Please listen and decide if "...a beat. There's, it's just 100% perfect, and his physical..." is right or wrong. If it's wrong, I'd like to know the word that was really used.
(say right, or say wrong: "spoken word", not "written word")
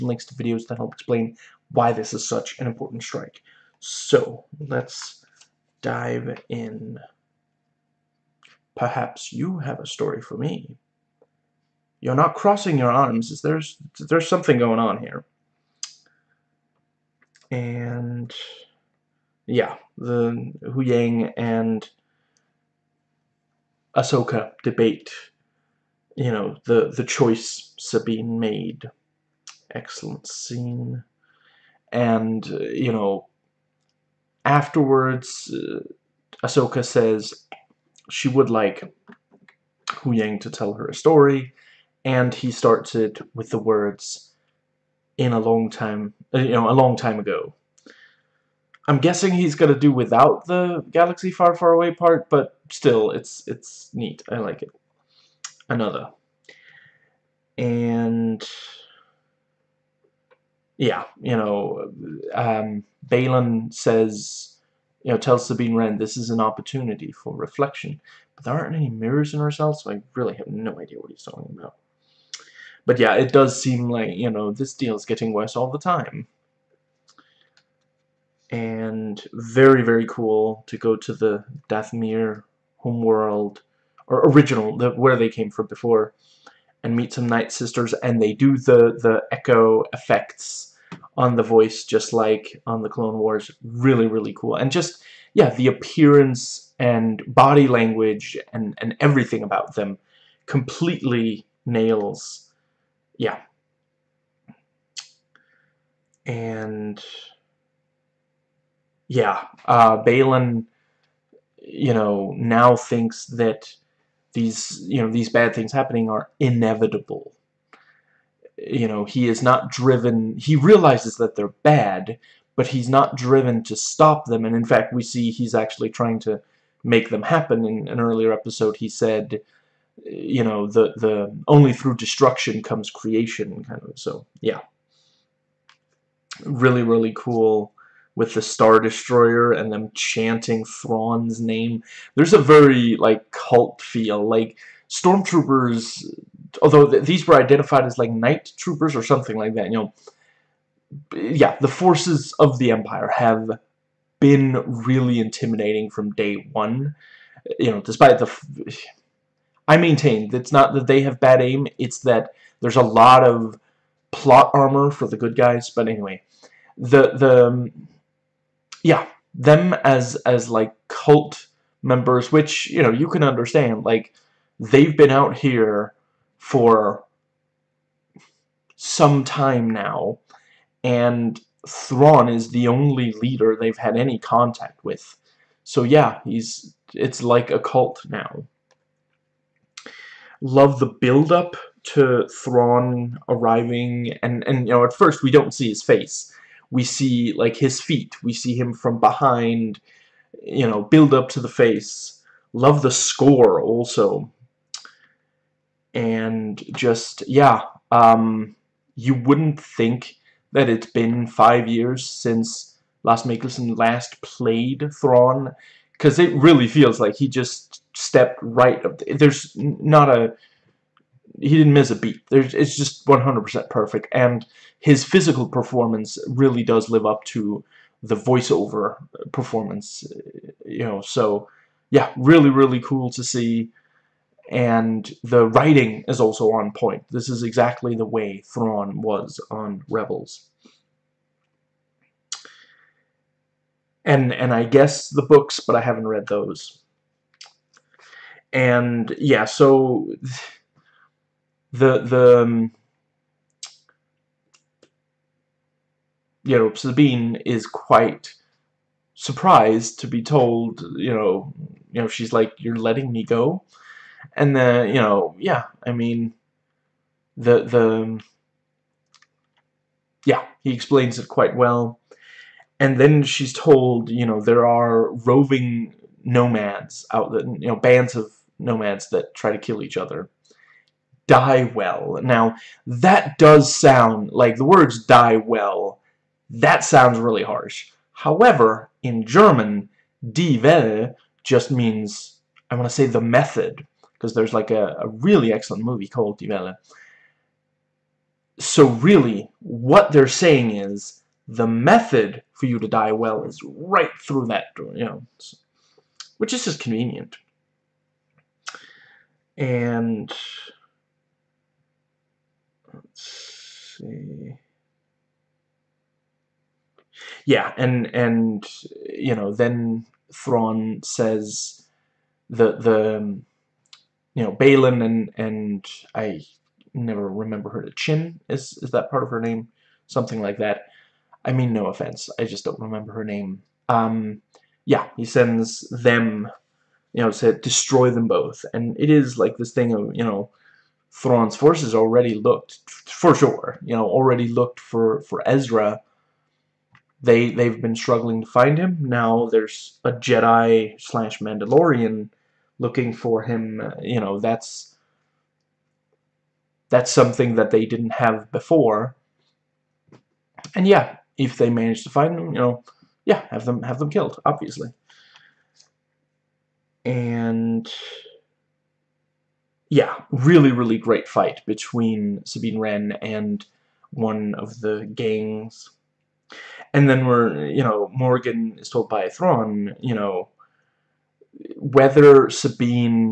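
right.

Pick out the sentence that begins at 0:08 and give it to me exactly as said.
Perhaps you have a story for me.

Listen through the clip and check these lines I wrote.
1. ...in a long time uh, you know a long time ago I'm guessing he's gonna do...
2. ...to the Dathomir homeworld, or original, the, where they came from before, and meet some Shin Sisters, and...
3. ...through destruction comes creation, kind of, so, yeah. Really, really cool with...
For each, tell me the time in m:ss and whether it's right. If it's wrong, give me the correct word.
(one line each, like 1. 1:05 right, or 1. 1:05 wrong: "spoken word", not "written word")
1. 0:45 right
2. 1:20 wrong: "Night", not "Shin"
3. 2:11 right.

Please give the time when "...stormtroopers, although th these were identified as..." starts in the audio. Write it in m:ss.
2:24.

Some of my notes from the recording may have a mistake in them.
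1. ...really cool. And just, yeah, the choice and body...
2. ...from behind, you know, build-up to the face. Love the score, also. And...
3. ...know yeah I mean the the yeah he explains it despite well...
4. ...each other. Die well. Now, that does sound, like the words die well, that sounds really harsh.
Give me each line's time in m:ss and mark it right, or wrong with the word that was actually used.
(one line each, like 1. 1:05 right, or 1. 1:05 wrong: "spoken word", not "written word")
1. 1:34 wrong: "appearance", not "choice"
2. 3:18 right
3. 4:25 wrong: "quite", not "despite"
4. 4:39 right.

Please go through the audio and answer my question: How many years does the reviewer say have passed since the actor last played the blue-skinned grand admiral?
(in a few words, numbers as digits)
5.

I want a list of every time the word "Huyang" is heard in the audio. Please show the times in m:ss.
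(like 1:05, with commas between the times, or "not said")
0:20, 0:39.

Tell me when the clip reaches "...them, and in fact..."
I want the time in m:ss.
2:04.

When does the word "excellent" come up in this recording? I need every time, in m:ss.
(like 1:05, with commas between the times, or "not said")
0:29, 4:55.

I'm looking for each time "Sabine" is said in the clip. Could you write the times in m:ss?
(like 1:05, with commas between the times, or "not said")
0:27, 1:05, 4:16, 6:12, 6:22.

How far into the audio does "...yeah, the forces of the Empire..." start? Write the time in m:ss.
2:31.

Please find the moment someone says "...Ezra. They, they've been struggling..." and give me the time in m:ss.
5:45.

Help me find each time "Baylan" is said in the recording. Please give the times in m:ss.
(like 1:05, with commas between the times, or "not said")
1:03, 1:50, 5:24.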